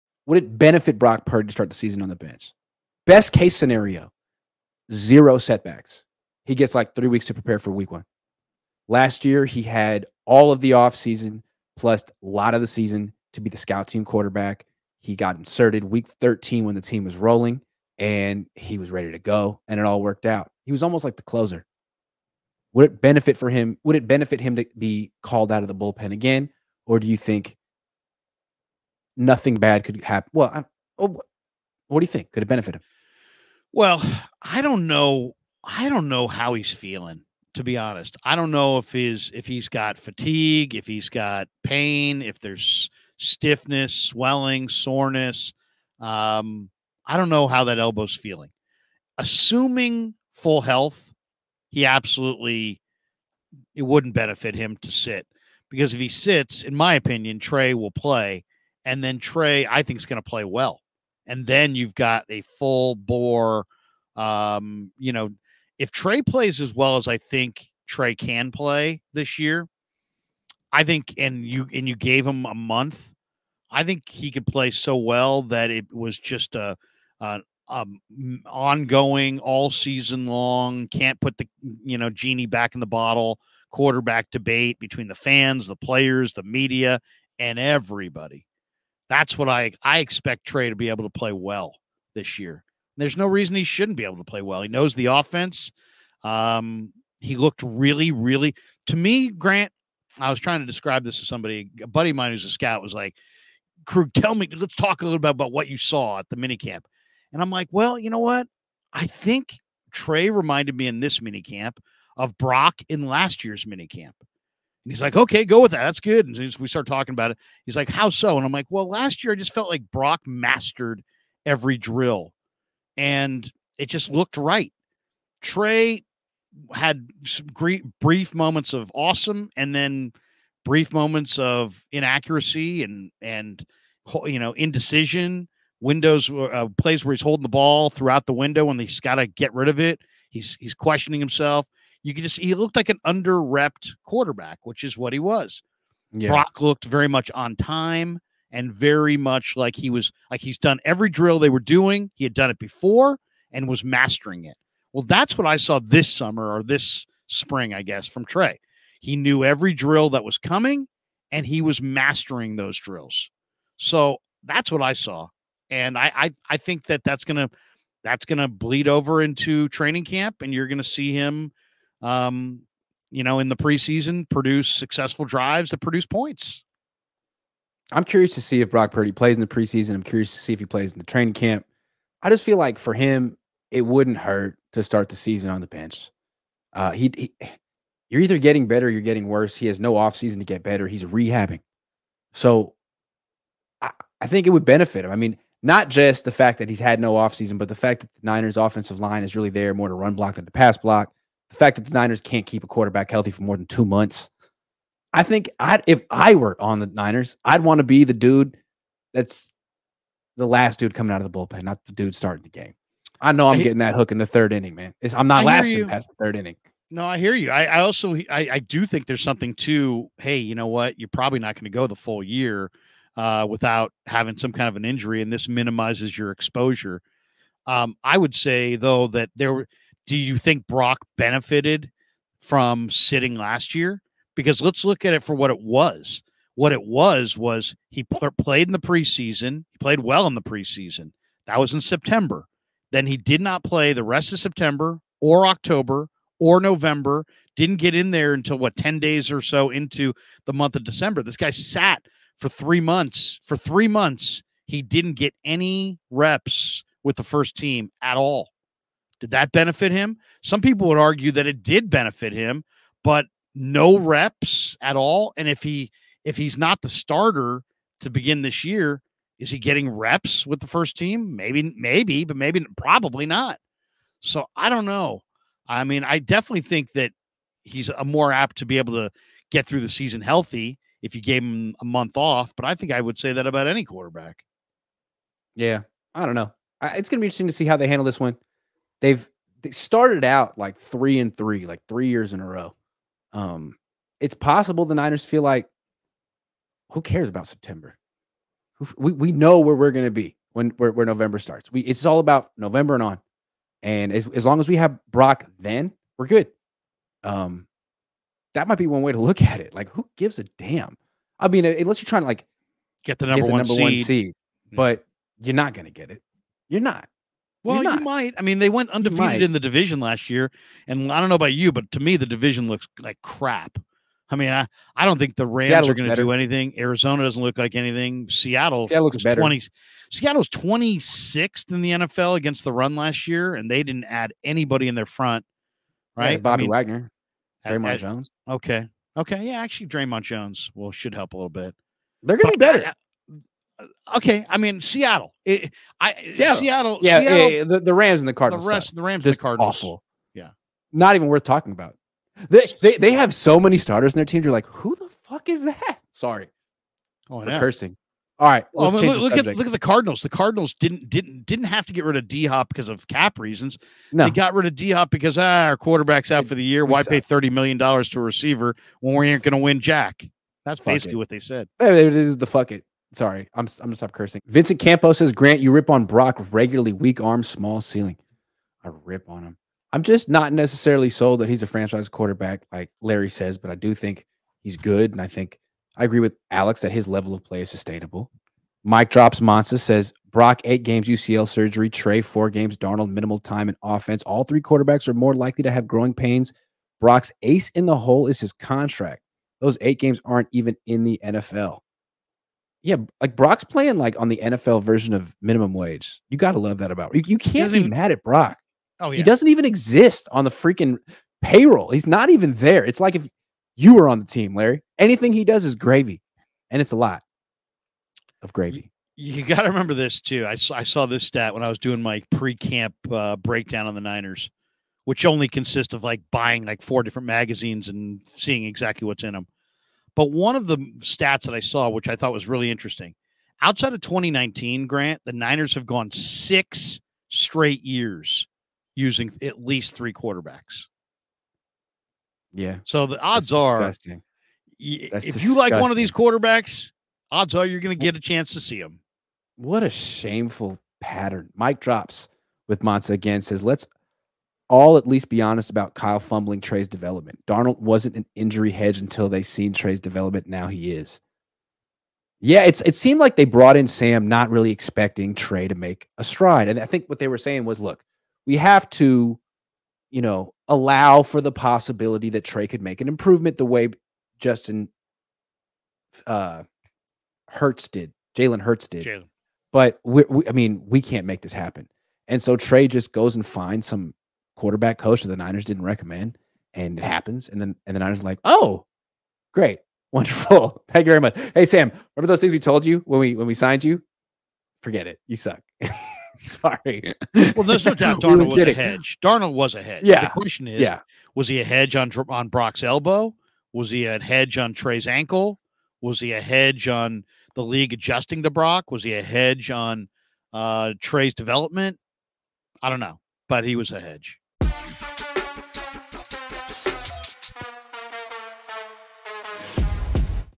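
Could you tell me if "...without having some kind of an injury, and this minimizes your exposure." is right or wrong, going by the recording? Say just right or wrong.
right.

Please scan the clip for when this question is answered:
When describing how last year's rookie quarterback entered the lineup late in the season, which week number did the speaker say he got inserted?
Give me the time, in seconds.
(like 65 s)
15 s.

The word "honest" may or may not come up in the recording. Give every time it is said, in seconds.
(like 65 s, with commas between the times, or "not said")
37 s, 455 s.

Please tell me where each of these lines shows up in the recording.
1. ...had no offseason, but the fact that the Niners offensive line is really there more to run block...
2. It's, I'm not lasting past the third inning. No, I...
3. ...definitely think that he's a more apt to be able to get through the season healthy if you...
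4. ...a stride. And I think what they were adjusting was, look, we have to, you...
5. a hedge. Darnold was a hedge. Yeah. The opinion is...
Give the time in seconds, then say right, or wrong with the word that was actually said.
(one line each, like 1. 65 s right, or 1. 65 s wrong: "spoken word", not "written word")
1. 196 s right
2. 215 s right
3. 276 s right
4. 466 s wrong: "saying", not "adjusting"
5. 498 s wrong: "question", not "opinion".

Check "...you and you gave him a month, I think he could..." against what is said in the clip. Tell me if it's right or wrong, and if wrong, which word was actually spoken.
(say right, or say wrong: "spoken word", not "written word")
right.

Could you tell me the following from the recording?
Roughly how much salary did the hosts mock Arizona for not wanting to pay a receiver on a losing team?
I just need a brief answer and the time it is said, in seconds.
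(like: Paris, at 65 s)
thirty million dollars, at 367 s.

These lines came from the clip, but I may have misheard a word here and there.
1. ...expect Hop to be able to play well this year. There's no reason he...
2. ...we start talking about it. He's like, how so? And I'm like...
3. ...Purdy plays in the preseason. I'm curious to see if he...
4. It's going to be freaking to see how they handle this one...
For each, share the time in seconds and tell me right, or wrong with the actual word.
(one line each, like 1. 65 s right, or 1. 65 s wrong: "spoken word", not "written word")
1. 89 s wrong: "Trey", not "Hop"
2. 116 s right
3. 178 s right
4. 286 s wrong: "interesting", not "freaking".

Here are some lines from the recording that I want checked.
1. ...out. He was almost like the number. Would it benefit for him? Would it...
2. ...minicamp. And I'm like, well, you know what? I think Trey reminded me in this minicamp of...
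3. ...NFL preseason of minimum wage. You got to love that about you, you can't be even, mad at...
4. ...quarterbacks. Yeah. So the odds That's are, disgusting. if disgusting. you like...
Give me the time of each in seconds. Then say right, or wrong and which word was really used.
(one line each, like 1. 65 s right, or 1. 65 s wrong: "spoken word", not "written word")
1. 20 s wrong: "closer", not "number"
2. 106 s right
3. 404 s wrong: "version", not "preseason"
4. 440 s right.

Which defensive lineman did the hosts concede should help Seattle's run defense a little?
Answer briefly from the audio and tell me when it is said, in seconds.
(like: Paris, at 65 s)
Dre'Mont Jones, at 339 s.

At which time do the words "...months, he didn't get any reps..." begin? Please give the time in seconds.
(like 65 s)
253 s.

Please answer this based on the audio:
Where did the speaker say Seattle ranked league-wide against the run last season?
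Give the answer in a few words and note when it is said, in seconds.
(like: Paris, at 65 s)
26th, at 330 s.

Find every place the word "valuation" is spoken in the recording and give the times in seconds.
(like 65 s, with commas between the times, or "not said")
not said.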